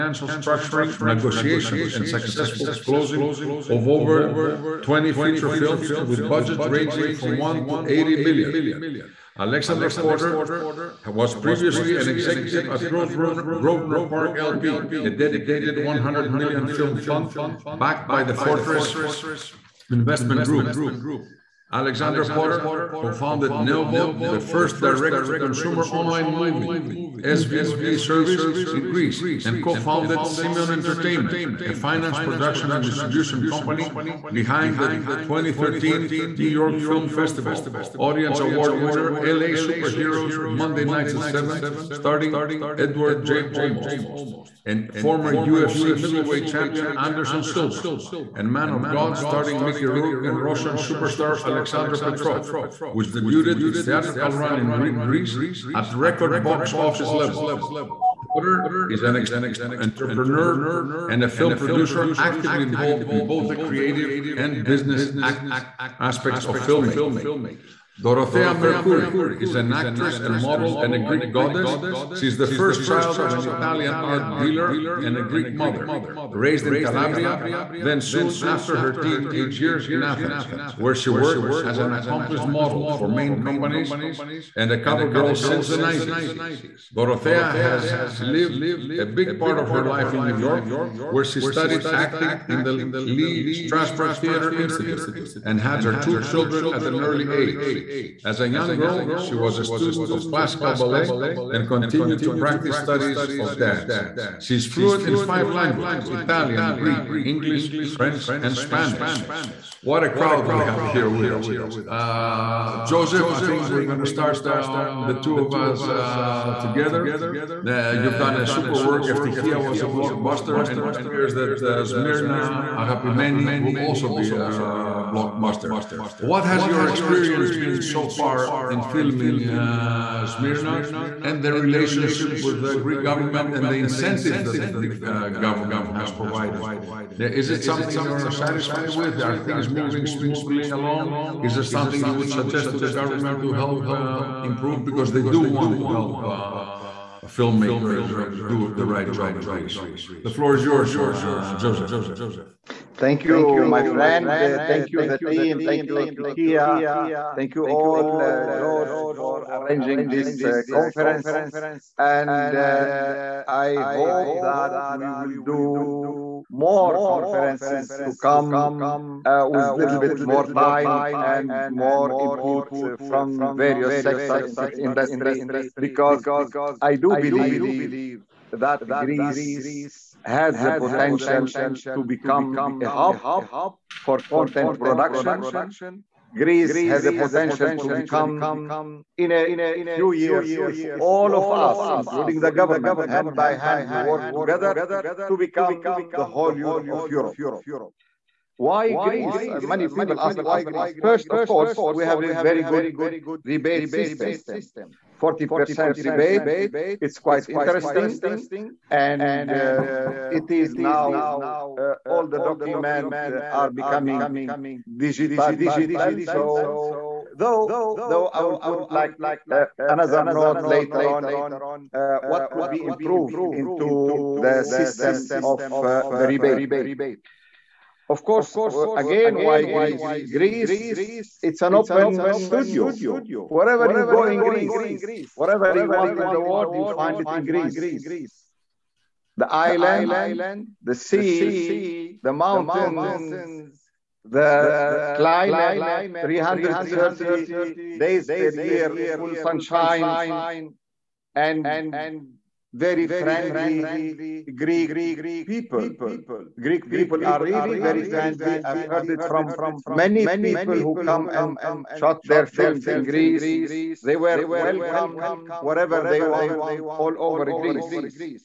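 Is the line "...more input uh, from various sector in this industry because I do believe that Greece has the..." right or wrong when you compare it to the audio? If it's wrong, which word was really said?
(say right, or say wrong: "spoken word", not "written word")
right.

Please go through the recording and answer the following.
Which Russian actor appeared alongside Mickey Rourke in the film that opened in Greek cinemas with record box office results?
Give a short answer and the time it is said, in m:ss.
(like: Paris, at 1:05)
Alexander Petrov, at 0:51.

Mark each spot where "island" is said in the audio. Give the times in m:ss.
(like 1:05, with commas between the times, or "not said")
3:59.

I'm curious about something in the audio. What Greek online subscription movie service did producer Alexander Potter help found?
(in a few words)
Neovod.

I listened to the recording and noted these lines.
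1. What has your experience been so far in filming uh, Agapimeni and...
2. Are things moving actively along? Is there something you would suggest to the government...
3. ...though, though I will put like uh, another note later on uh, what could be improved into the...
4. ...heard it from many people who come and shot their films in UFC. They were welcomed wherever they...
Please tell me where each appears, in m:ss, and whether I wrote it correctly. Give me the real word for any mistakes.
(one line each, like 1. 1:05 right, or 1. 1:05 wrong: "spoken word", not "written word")
1. 2:06 wrong: "Smyrna", not "Agapimeni"
2. 2:19 wrong: "smoothly", not "actively"
3. 3:37 right
4. 4:18 wrong: "Greece", not "UFC".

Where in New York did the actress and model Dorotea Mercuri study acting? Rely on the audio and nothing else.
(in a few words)
Lee Strasberg Theater Institute.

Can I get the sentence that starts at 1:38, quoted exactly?
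As a young girl, she was a student of classical ballet and continued to practice studies of dance.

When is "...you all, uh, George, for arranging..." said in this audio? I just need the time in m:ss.
2:37.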